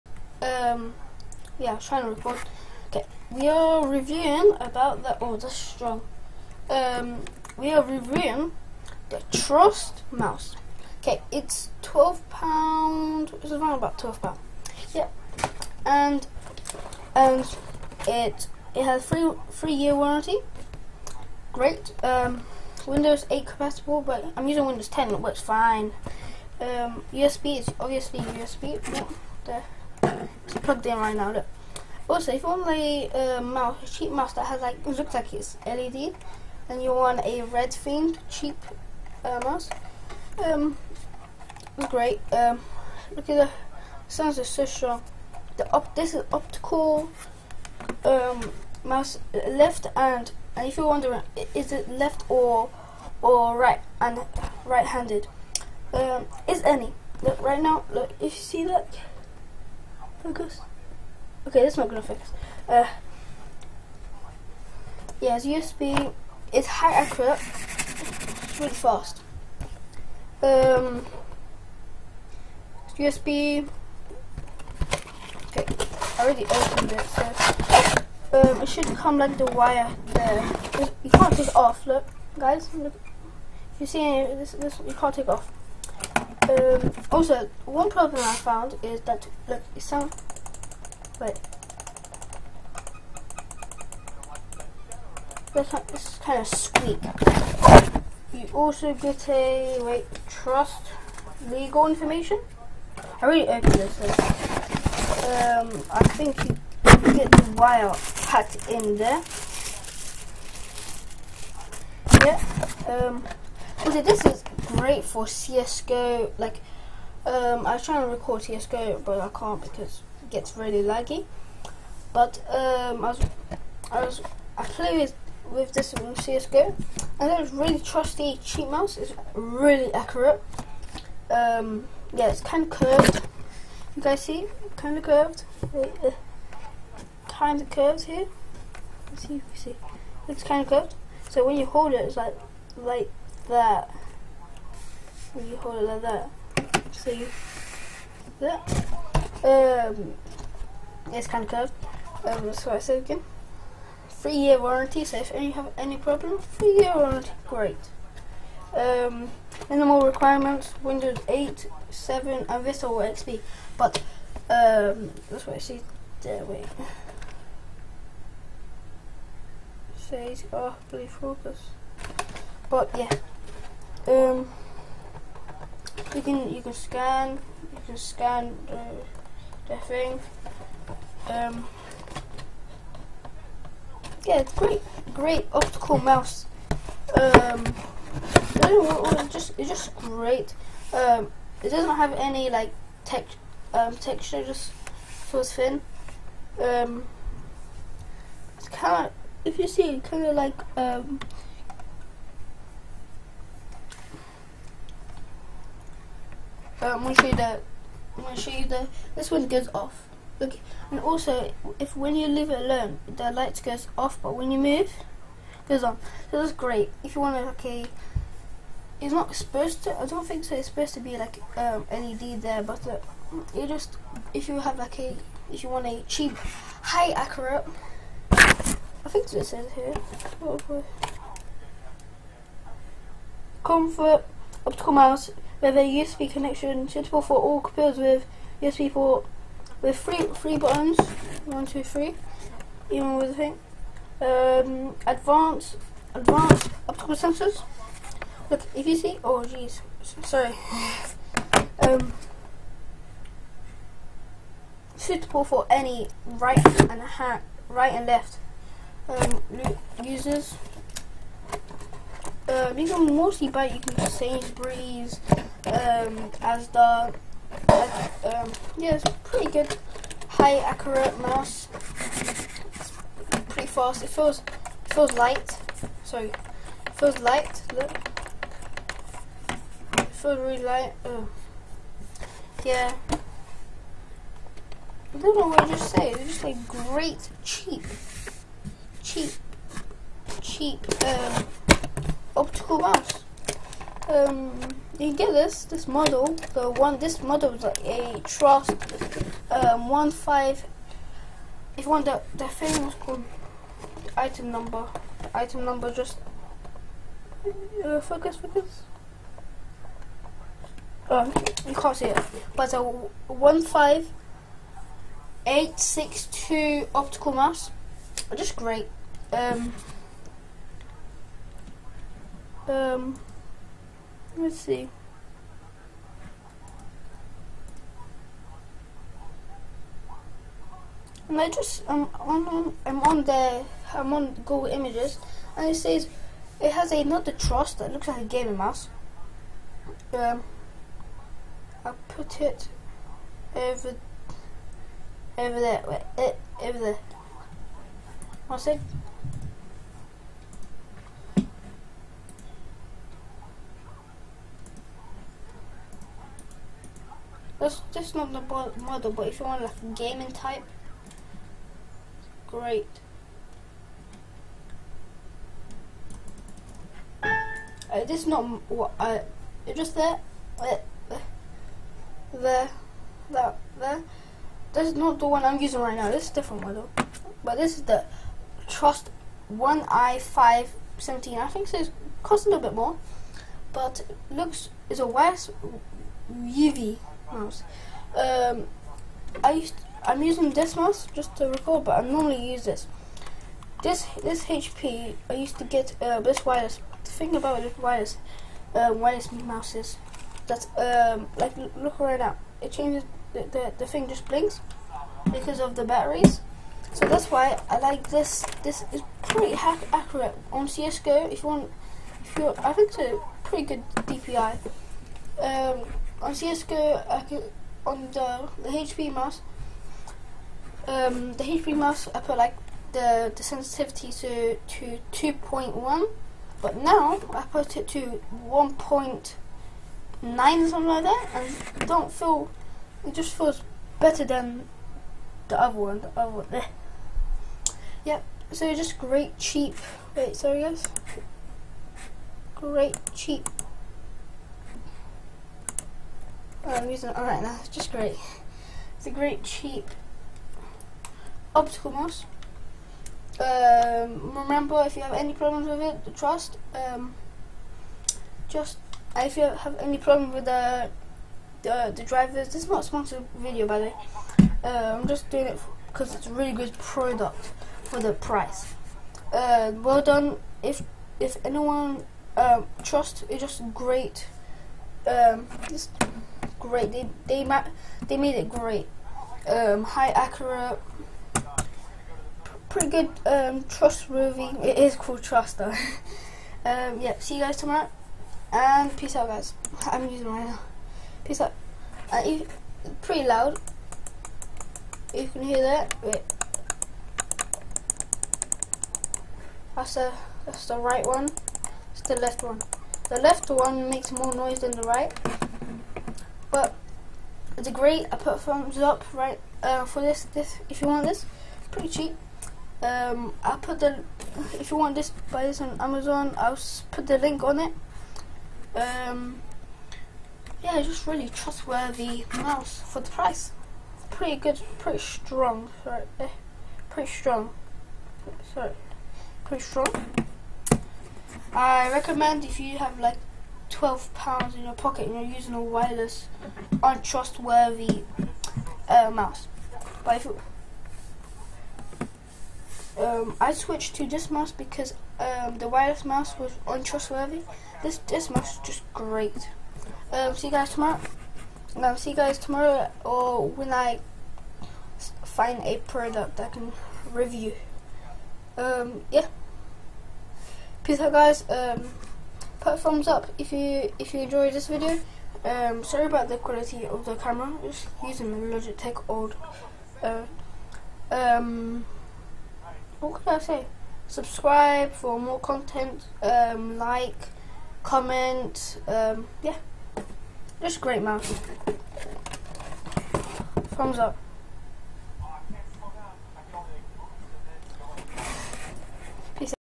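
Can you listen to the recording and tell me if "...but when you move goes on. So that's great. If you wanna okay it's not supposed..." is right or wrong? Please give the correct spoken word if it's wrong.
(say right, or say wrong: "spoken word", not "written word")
right.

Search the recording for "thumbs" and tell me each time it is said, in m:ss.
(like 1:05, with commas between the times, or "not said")
8:28, 9:22, 9:43.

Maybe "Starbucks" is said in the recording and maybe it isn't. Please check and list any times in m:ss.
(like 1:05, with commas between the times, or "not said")
not said.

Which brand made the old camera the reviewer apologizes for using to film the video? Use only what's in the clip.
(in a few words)
Logitech.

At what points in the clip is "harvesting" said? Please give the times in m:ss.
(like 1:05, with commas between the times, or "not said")
not said.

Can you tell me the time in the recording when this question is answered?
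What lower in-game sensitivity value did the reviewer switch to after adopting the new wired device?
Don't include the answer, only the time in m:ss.
7:08.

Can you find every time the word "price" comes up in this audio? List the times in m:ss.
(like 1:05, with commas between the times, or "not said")
7:48, 8:43.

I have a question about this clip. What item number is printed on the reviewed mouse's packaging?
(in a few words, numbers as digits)
15862.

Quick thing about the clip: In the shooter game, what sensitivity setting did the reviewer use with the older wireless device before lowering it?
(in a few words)
2.1.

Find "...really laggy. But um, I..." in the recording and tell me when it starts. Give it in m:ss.
2:00.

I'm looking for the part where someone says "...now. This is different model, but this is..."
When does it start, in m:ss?
6:15.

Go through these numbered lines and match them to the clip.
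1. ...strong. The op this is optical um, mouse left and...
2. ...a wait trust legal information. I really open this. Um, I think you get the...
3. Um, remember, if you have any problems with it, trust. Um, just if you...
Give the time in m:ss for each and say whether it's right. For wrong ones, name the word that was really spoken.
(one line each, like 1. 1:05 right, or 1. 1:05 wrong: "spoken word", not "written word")
1. 0:44 right
2. 1:39 right
3. 7:33 right.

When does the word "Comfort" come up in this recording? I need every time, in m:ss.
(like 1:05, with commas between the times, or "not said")
3:53.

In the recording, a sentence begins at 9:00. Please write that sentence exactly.
But if um, I switched to this mouse because um, the wireless mouse was untrustworthy.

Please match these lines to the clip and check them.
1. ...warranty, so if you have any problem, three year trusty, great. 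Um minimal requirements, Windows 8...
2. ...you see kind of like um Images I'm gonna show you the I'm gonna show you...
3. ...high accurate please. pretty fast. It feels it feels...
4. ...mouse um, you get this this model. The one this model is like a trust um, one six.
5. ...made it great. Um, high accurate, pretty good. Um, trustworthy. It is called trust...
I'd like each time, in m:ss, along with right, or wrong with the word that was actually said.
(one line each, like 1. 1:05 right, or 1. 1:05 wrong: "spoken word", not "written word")
1. 2:34 wrong: "warranty", not "trusty"
2. 3:19 wrong: "But", not "Images"
3. 4:30 wrong: "mouse", not "please"
4. 4:52 wrong: "five", not "six"
5. 7:58 right.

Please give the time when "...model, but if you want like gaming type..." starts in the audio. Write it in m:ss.
5:58.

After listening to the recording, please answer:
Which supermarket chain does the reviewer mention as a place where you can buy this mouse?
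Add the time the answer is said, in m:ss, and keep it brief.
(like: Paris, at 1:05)
Sainsbury's, at 4:24.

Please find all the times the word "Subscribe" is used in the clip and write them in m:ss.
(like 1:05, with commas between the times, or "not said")
9:34.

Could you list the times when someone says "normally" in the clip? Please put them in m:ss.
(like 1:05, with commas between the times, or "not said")
6:32.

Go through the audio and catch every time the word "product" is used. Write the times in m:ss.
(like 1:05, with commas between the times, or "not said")
7:46, 9:15.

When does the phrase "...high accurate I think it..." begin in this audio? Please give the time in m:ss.
3:46.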